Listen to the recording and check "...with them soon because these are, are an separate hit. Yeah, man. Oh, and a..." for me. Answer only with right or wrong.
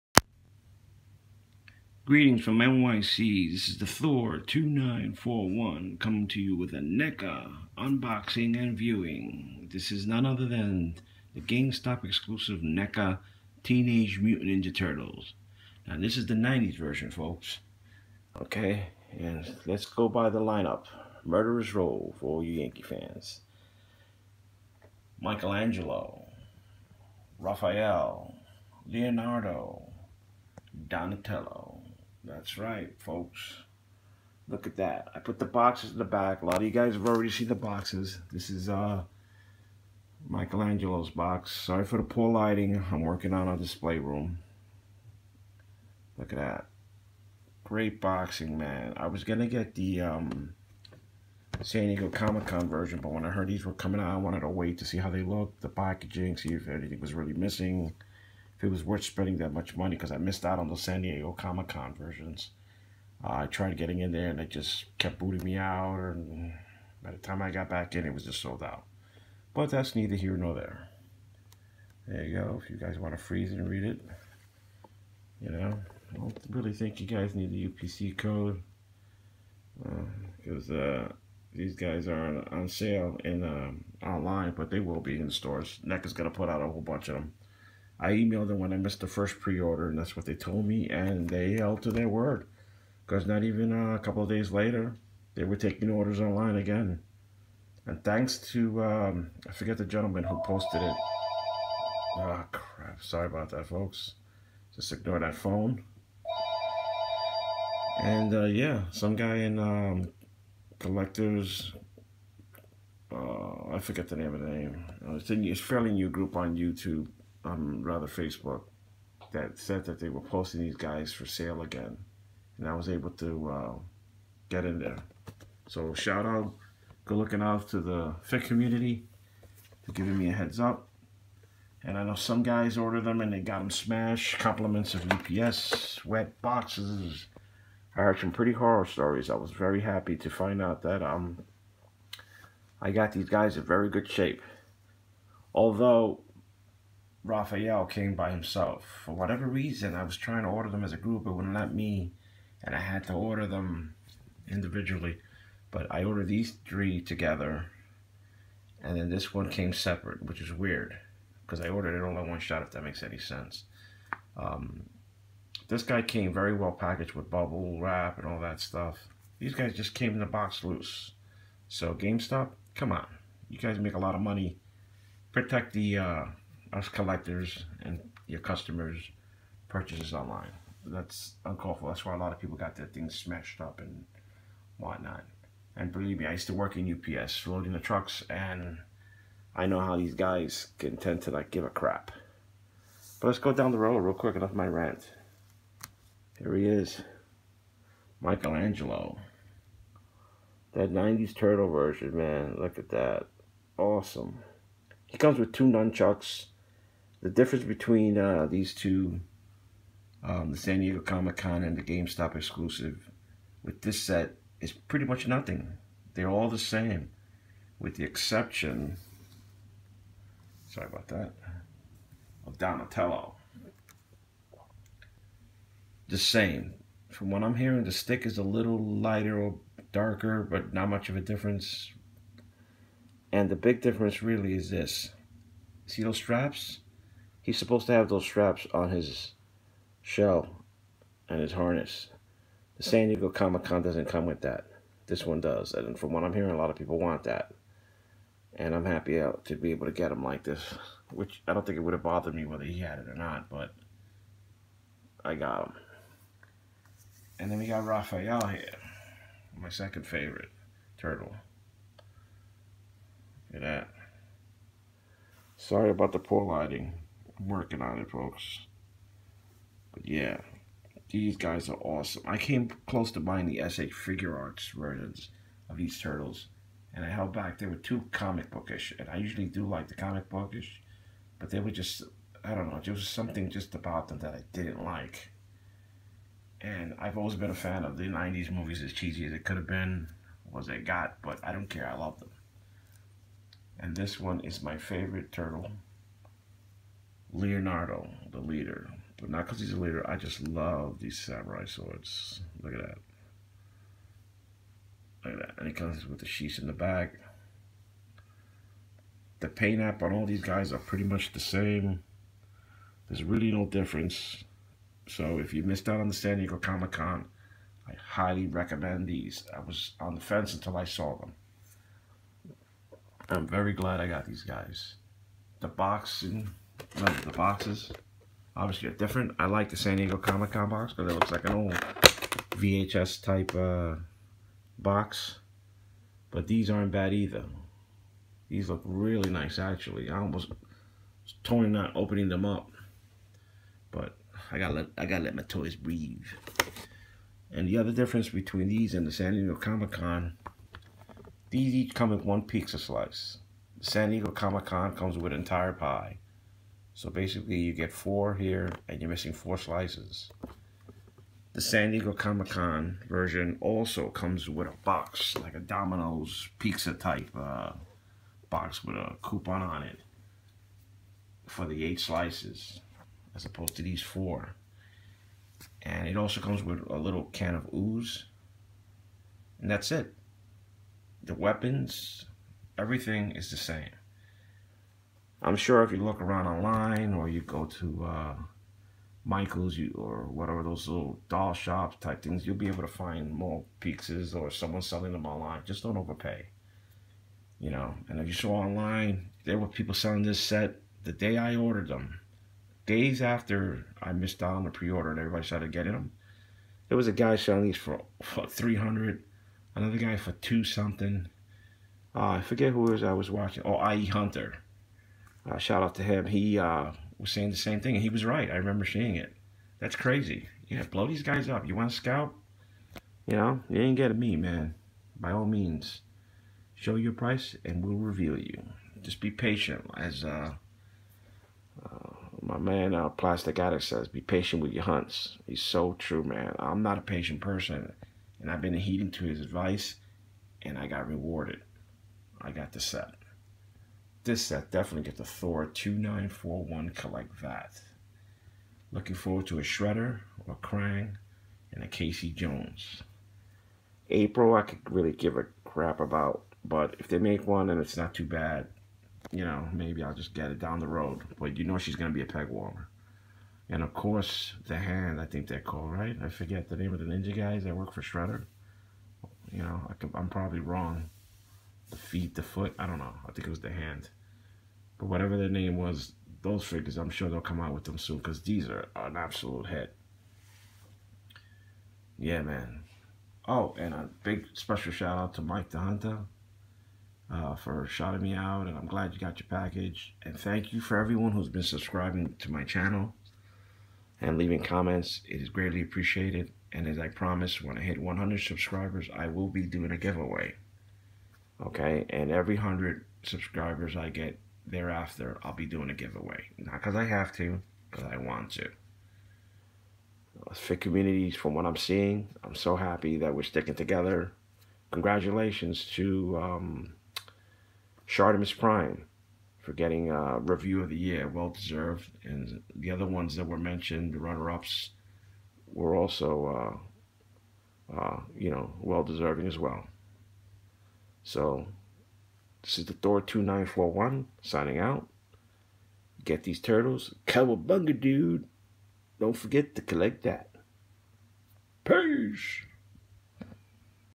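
wrong.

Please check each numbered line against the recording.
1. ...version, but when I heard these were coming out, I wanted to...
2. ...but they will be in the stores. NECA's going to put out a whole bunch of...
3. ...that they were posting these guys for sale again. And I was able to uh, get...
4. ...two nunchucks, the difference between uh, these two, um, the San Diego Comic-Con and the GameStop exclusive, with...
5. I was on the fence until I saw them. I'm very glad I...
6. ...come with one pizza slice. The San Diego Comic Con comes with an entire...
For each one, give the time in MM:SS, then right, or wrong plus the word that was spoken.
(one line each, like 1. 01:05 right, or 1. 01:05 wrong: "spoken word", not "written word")
1. 00:52 right
2. 01:24 right
3. 01:59 right
4. 03:25 right
5. 05:19 right
6. 05:51 right.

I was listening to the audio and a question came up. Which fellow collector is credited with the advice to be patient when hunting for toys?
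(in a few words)
Plastic Addict.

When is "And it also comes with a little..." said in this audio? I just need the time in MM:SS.
06:15.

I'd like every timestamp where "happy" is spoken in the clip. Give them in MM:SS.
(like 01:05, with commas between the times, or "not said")
02:19, 04:08, 08:32.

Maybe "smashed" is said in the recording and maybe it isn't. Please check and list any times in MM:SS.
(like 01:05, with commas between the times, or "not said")
02:13, 03:03.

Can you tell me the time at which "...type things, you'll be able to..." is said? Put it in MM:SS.
06:31.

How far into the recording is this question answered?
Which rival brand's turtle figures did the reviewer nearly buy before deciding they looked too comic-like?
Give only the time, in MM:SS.
04:33.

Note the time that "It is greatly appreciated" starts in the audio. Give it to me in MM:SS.
08:15.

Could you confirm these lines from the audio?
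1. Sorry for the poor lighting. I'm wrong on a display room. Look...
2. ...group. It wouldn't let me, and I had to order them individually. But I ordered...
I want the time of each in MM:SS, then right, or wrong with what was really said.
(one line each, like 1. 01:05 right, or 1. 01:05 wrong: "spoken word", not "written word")
1. 00:41 wrong: "working", not "wrong"
2. 02:30 right.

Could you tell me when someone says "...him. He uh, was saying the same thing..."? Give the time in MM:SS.
06:56.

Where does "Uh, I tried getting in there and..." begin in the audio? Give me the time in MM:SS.
01:03.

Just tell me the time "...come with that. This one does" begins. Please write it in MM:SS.
04:04.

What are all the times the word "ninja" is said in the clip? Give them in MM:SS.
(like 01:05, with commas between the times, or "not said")
00:14, 07:47.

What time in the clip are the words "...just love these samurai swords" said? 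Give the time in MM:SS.
05:00.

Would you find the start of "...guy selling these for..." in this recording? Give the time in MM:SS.
06:47.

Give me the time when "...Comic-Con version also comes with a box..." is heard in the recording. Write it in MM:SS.
06:02.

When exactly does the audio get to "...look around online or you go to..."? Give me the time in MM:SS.
06:25.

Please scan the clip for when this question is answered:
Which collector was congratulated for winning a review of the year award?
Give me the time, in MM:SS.
08:38.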